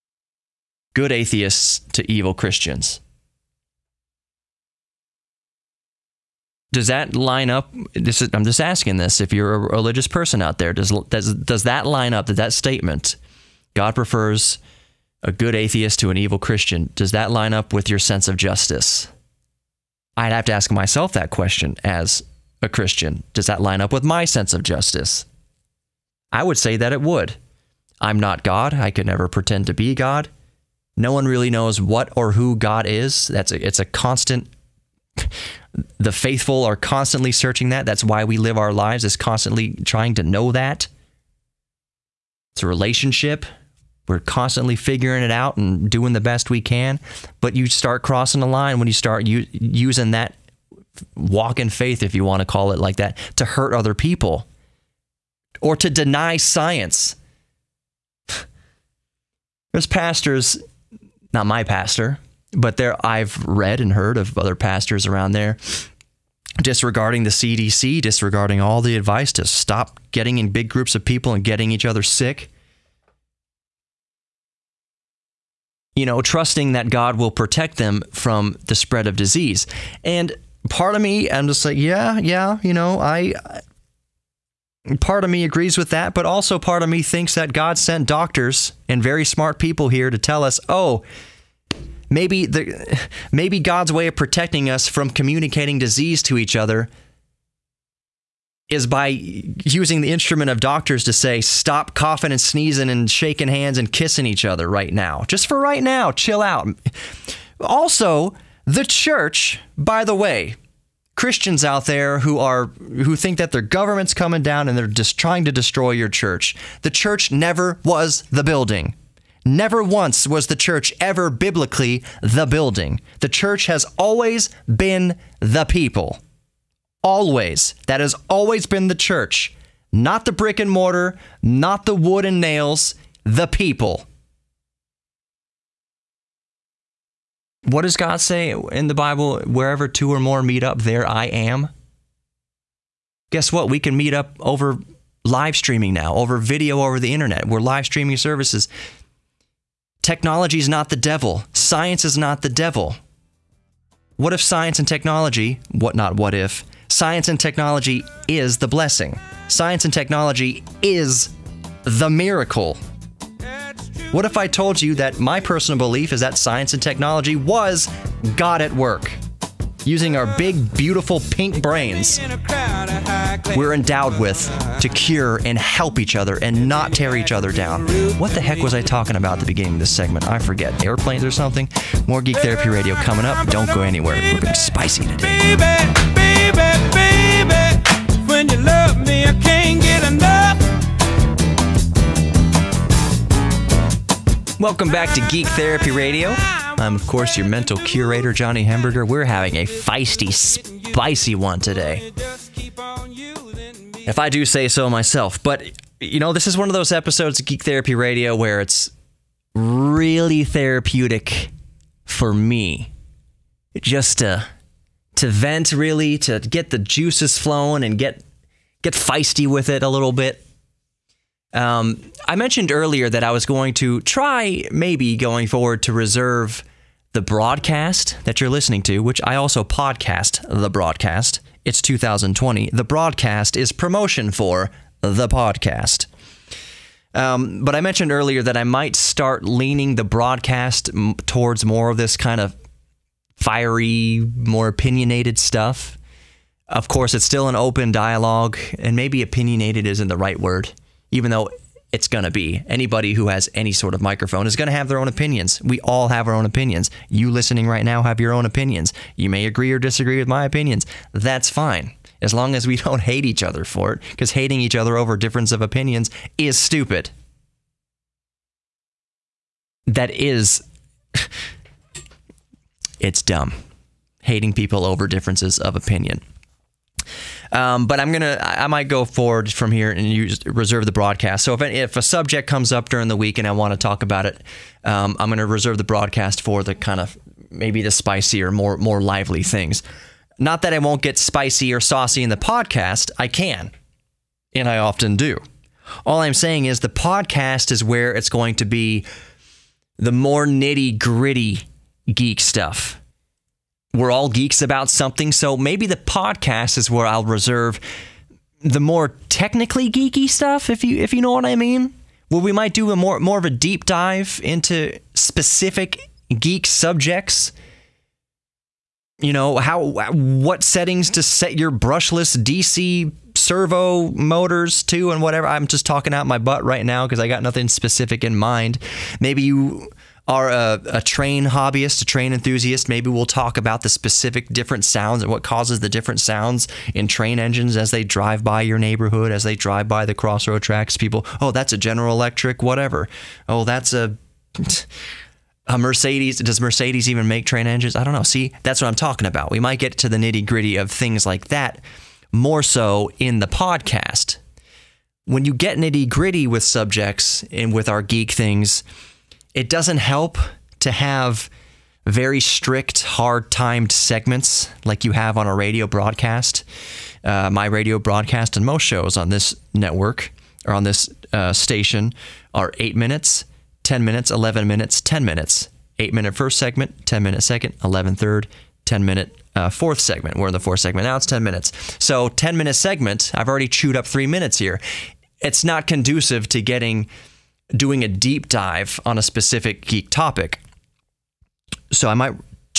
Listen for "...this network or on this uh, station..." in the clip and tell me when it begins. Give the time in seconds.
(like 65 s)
369 s.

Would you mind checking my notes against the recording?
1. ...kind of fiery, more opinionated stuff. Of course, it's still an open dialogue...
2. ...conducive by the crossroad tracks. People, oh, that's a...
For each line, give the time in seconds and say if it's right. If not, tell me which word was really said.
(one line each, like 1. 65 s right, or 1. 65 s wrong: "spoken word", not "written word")
1. 242 s right
2. 339 s wrong: "drive", not "conducive".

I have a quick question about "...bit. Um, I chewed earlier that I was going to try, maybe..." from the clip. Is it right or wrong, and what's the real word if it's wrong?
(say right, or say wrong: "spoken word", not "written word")
wrong: "mentioned", not "chewed".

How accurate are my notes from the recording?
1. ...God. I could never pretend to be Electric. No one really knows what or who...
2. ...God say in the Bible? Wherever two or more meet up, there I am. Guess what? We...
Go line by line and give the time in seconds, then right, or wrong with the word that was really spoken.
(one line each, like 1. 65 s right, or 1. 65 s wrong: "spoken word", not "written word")
1. 28 s wrong: "God", not "Electric"
2. 137 s right.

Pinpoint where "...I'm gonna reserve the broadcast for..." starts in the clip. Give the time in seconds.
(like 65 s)
285 s.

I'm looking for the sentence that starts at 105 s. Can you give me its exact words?
Just for right now, chill out.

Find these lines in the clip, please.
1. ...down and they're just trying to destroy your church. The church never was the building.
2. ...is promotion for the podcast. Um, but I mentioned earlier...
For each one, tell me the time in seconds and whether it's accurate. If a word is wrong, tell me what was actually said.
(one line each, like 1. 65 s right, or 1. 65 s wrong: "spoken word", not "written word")
1. 114 s right
2. 233 s right.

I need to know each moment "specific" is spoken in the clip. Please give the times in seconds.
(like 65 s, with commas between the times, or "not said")
315 s, 327 s, 333 s, 389 s.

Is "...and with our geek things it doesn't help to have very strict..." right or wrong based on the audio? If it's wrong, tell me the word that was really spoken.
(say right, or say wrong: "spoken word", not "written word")
right.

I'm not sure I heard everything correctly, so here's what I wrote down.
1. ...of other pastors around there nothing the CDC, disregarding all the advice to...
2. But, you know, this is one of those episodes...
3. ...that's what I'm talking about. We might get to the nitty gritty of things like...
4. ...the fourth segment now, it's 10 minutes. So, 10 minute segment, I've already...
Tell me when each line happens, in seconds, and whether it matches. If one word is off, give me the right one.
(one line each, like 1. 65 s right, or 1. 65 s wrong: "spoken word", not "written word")
1. 64 s wrong: "disregarding", not "nothing"
2. 205 s right
3. 348 s right
4. 380 s right.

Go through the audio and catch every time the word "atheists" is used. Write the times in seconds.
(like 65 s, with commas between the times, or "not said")
1 s, 15 s.